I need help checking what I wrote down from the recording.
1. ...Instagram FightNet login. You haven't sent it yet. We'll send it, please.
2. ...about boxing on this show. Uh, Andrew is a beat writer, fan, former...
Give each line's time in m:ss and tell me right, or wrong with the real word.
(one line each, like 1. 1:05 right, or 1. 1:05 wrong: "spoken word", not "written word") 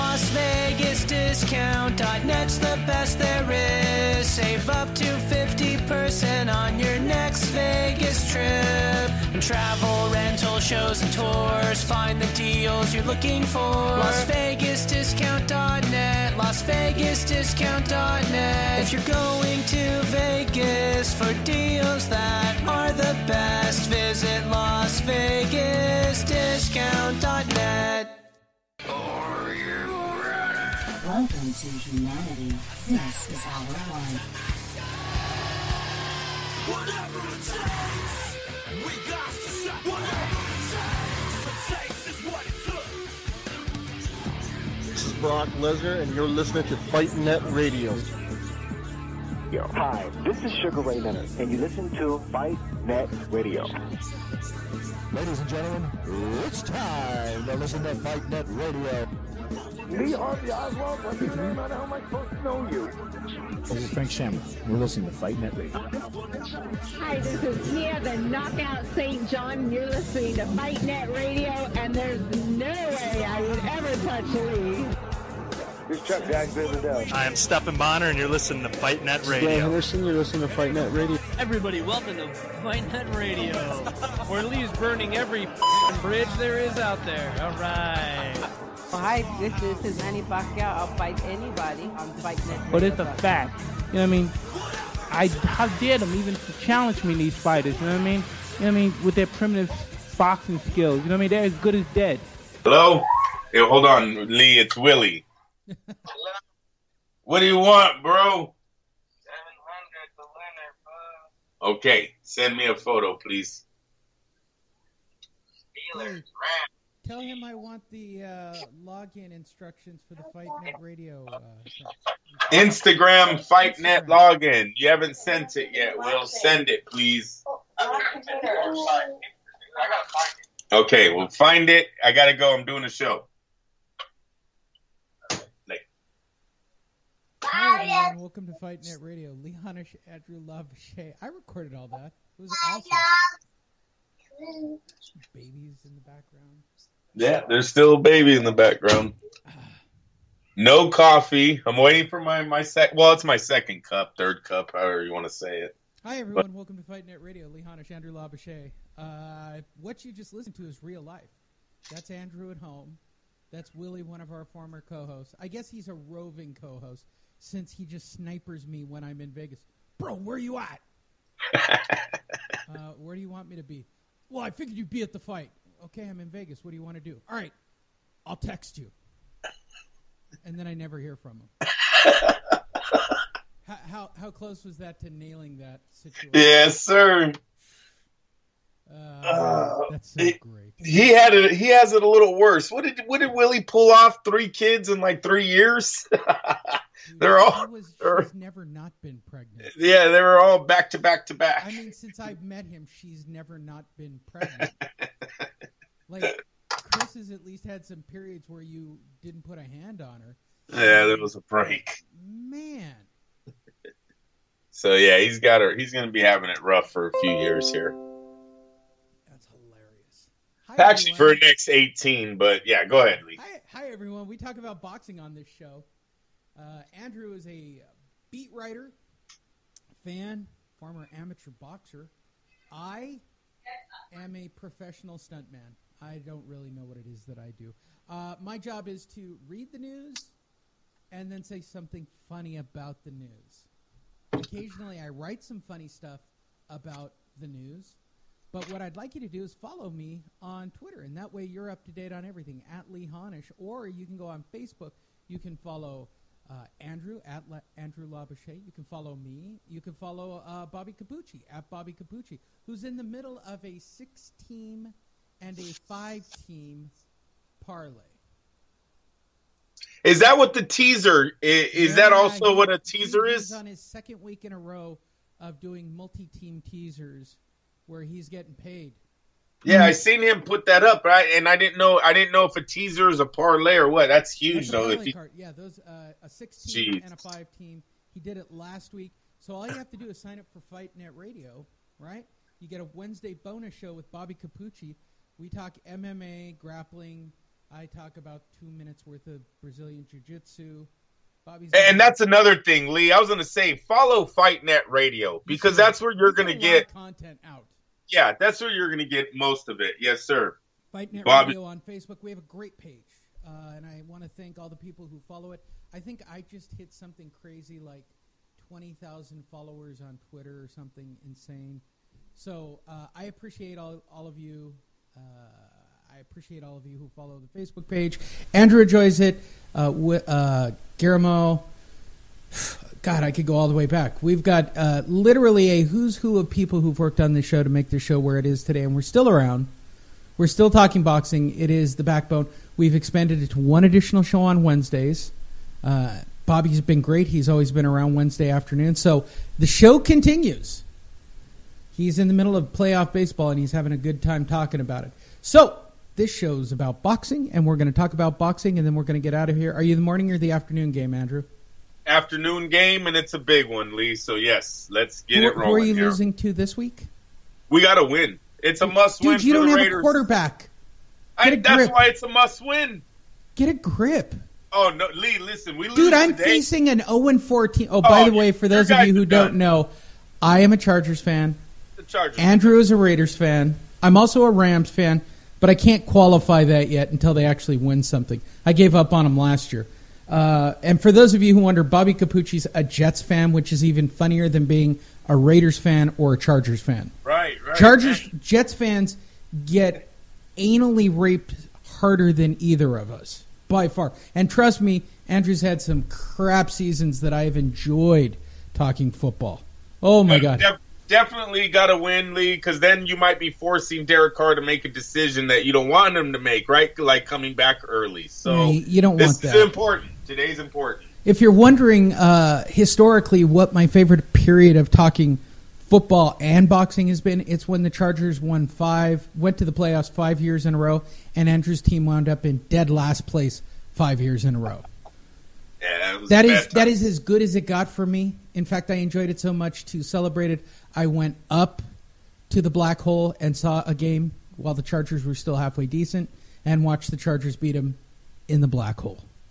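1. 2:02 right
2. 3:44 right.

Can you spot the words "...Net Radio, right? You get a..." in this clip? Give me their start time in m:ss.
4:50.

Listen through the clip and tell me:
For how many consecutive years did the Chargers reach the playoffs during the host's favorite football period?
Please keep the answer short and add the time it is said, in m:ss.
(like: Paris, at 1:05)
5, at 7:09.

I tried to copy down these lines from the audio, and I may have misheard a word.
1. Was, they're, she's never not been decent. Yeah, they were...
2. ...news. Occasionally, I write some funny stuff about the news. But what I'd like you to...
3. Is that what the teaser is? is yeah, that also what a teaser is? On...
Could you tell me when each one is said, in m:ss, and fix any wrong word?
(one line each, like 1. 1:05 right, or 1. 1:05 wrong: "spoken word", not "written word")
1. 3:17 wrong: "pregnant", not "decent"
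2. 4:03 right
3. 4:30 right.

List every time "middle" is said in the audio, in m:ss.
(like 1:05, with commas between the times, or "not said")
4:23, 5:52.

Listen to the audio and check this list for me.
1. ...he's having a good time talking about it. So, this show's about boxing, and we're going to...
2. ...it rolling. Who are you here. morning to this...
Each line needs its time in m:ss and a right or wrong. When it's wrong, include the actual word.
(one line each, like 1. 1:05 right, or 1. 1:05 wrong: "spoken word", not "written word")
1. 5:53 right
2. 6:05 wrong: "losing", not "morning".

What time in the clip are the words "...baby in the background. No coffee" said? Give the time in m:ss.
2:27.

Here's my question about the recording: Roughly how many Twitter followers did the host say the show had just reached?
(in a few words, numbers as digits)
20,000.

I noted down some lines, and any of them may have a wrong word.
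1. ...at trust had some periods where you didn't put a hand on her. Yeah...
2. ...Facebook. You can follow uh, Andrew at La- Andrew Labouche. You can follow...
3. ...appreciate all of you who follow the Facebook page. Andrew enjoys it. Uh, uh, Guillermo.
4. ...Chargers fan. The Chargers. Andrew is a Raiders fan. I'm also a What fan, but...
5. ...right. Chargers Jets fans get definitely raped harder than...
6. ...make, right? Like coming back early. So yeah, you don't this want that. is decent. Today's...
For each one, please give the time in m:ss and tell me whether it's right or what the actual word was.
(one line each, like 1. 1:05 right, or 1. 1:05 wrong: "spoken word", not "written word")
1. 3:27 wrong: "least", not "trust"
2. 4:14 right
3. 5:26 right
4. 6:20 wrong: "Rams", not "What"
5. 6:37 wrong: "anally", not "definitely"
6. 6:56 wrong: "important", not "decent".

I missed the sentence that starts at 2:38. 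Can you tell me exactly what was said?
Uh, what you just listened to is real life.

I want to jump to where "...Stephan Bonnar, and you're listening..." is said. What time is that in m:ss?
1:17.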